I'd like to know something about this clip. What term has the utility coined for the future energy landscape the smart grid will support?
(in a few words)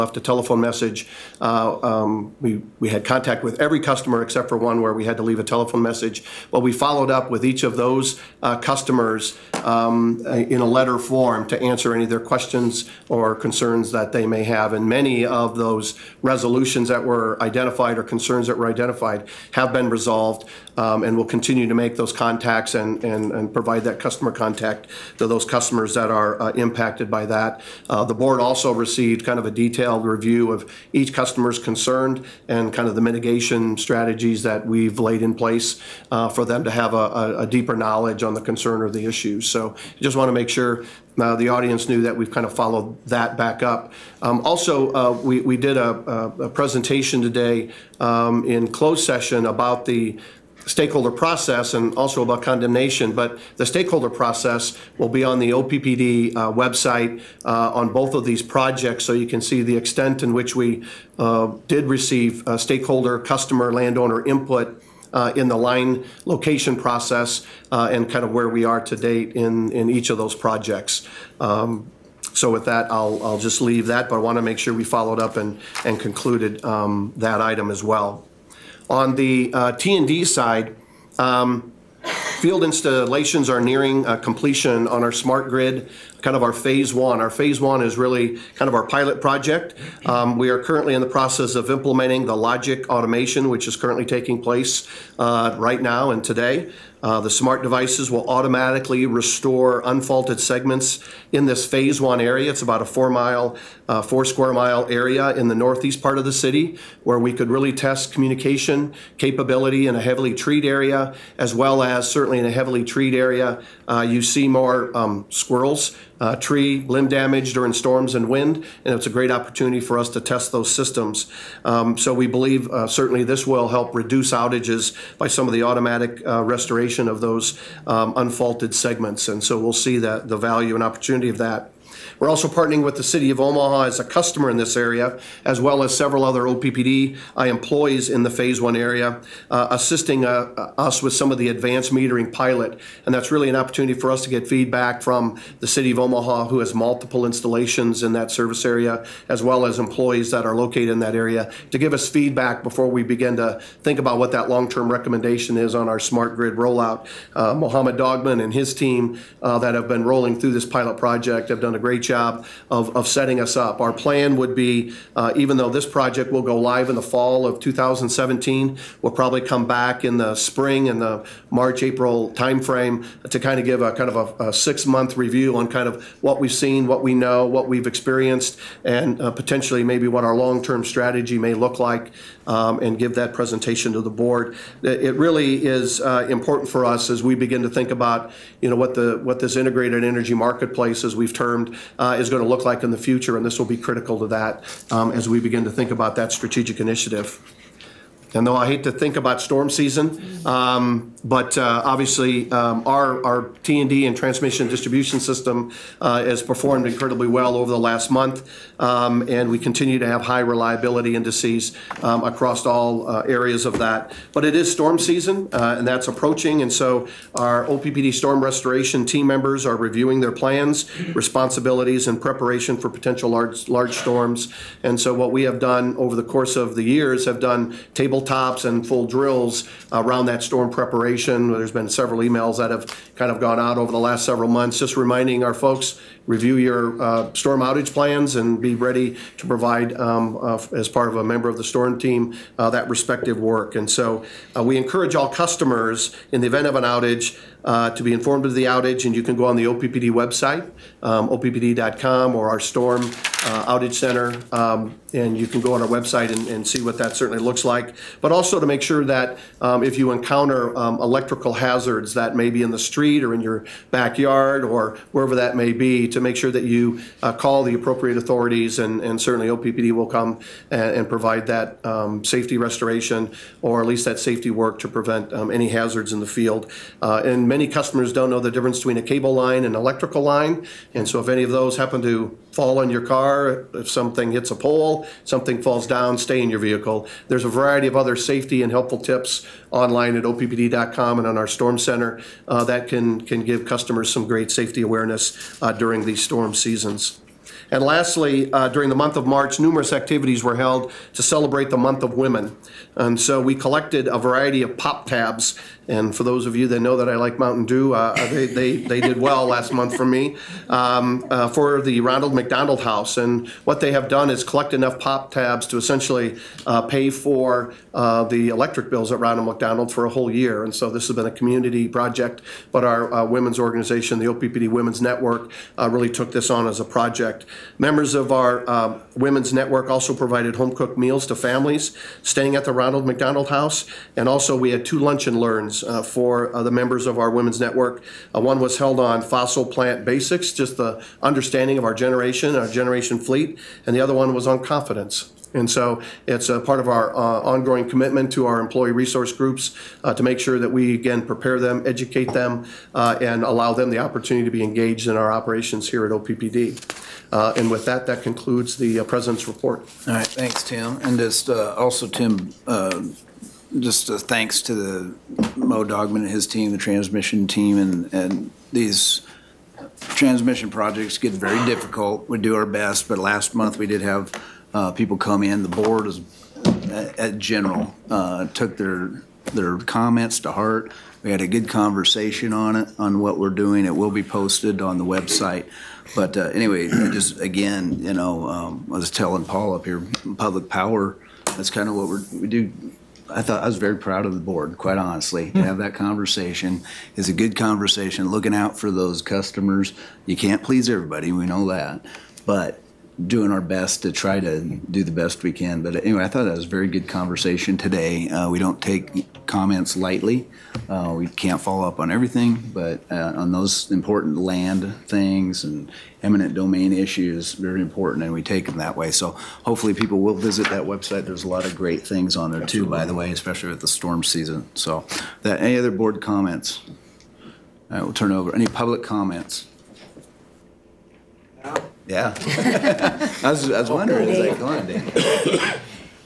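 Integrated energy marketplace.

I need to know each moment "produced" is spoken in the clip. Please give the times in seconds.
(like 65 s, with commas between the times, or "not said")
not said.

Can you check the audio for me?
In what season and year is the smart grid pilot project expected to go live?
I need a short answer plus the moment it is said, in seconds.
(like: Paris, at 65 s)
Fall of 2017, at 167 s.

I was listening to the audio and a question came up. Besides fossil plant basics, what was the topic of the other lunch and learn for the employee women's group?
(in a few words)
Confidence.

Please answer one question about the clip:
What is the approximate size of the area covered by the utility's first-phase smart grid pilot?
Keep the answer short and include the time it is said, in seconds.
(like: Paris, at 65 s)
4 square miles, at 104 s.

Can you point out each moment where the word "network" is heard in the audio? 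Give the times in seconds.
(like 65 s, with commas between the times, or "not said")
325 s, 329 s, 337 s.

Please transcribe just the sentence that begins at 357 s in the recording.
Uh, and with that, that concludes the uh, President's report.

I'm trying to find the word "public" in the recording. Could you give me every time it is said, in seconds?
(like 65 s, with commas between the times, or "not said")
390 s, 428 s.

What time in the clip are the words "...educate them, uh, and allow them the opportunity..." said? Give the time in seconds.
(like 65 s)
351 s.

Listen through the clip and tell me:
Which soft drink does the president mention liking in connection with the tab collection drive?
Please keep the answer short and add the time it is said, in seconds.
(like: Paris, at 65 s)
Mountain Dew, at 307 s.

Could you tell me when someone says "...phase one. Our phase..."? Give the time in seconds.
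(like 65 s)
86 s.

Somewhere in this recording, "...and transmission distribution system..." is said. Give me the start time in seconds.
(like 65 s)
204 s.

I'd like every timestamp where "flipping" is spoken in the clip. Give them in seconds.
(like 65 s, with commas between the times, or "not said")
not said.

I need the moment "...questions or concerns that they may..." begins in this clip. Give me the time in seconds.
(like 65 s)
12 s.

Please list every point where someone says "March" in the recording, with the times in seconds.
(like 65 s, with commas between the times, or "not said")
171 s, 299 s.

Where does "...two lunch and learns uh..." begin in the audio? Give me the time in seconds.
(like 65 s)
334 s.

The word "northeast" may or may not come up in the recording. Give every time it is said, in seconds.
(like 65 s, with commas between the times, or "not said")
105 s.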